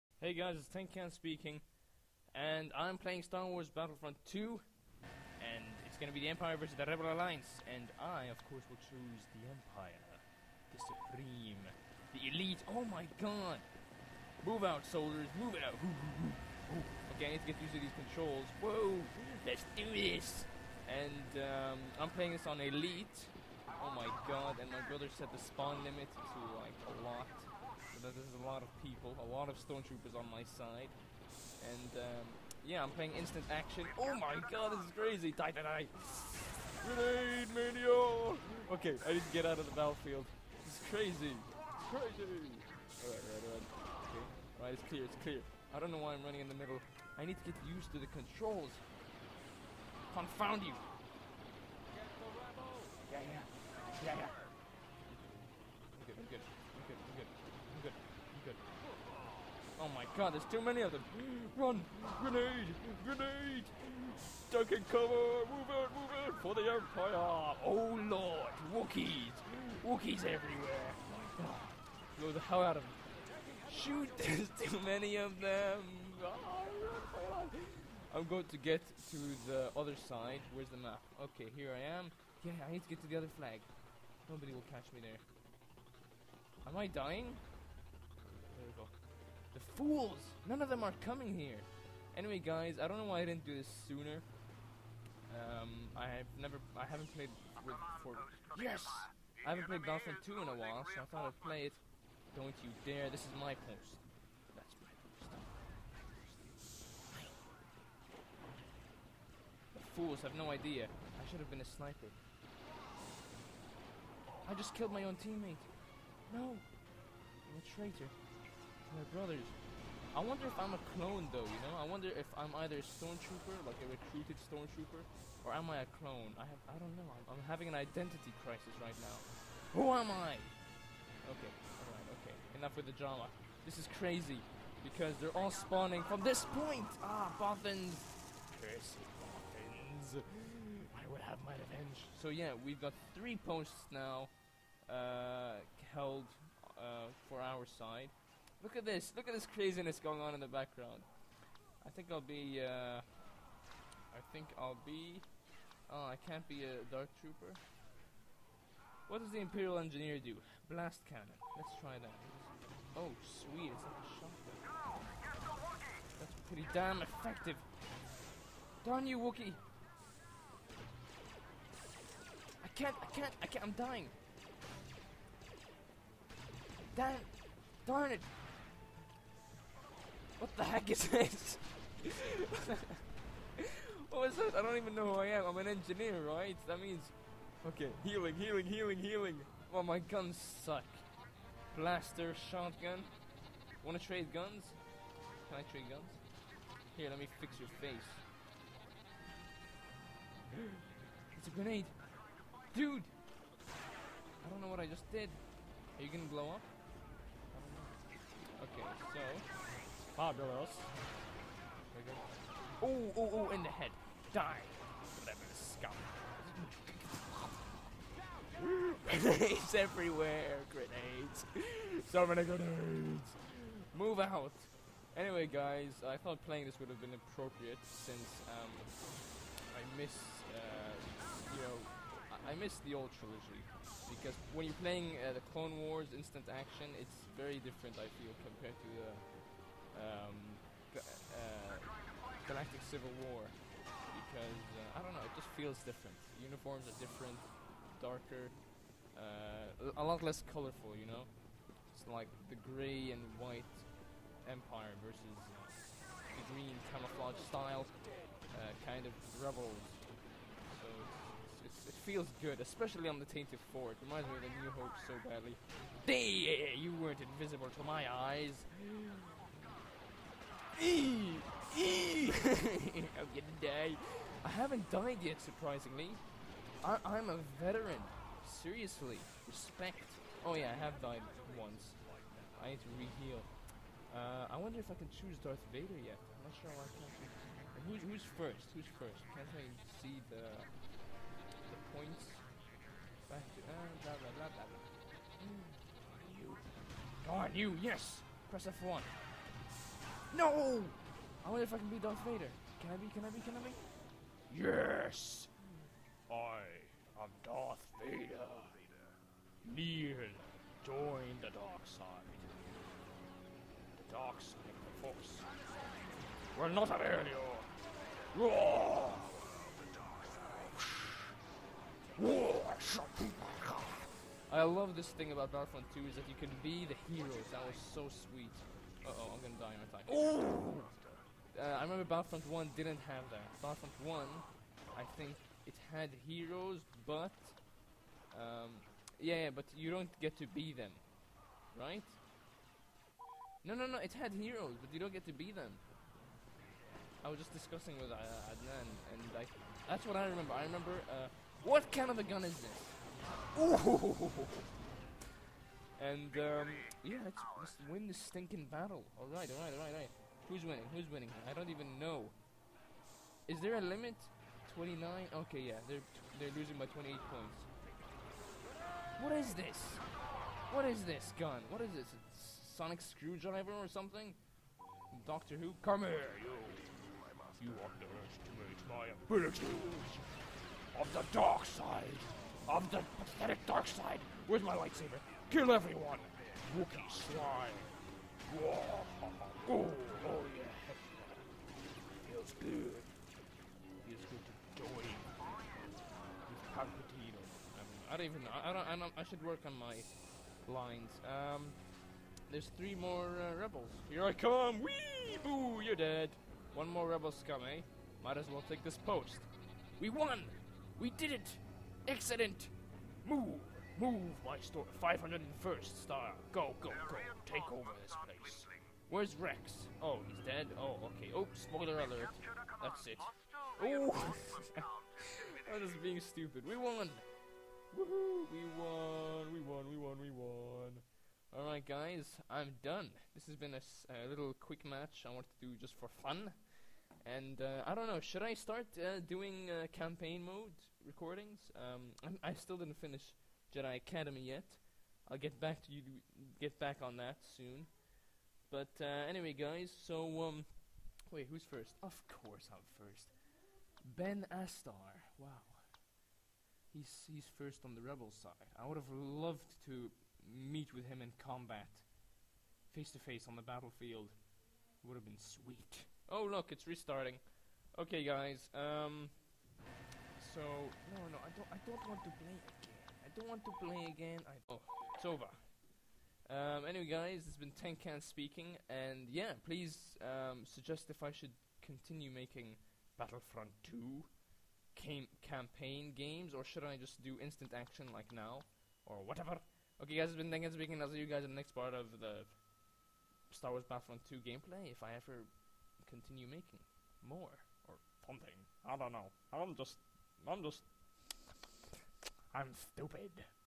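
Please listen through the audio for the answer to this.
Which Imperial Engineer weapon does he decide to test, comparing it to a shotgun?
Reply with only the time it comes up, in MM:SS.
02:40.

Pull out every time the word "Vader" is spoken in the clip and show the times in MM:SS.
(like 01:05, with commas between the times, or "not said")
04:45, 05:02, 05:08.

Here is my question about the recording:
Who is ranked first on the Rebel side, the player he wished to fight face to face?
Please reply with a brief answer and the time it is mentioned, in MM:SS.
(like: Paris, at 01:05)
Ben Astar, at 07:34.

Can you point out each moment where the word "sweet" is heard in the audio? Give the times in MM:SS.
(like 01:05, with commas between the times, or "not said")
02:43, 05:28, 07:45.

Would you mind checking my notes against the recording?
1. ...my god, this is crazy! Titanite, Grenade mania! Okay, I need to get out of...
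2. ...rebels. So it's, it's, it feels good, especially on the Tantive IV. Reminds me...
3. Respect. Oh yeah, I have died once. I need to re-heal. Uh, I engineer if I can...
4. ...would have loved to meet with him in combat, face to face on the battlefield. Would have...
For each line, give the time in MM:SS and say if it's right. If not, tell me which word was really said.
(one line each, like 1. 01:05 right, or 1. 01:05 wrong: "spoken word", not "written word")
1. 00:34 right
2. 04:19 right
3. 04:39 wrong: "wonder", not "engineer"
4. 07:38 right.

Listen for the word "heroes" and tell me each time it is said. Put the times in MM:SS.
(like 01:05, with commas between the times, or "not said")
05:27, 05:36, 05:44.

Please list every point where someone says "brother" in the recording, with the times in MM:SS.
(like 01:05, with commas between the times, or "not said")
00:24, 01:59.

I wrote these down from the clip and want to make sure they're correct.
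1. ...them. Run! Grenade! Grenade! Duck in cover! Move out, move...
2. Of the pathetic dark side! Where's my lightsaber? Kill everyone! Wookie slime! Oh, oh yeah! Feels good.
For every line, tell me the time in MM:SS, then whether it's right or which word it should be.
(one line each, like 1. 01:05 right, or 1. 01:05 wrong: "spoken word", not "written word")
1. 01:00 right
2. 06:22 right.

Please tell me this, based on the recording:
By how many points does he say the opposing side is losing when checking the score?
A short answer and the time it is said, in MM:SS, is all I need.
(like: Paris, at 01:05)
28, at 06:06.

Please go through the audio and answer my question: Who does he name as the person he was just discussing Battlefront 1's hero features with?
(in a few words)
Adnan.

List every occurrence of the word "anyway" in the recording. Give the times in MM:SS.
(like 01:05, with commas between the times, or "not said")
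01:32, 03:45, 07:29, 07:56.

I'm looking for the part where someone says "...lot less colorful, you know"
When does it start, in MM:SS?
04:10.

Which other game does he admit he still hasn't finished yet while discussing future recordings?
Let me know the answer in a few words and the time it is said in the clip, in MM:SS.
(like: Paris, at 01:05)
Jedi Academy, at 07:23.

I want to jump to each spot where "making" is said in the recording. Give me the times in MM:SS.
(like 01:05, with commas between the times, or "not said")
08:02, 08:16.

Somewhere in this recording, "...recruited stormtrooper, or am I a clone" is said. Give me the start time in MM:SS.
02:03.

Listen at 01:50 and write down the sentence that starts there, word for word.
I should have been a sniper.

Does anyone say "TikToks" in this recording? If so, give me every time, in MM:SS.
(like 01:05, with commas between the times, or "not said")
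not said.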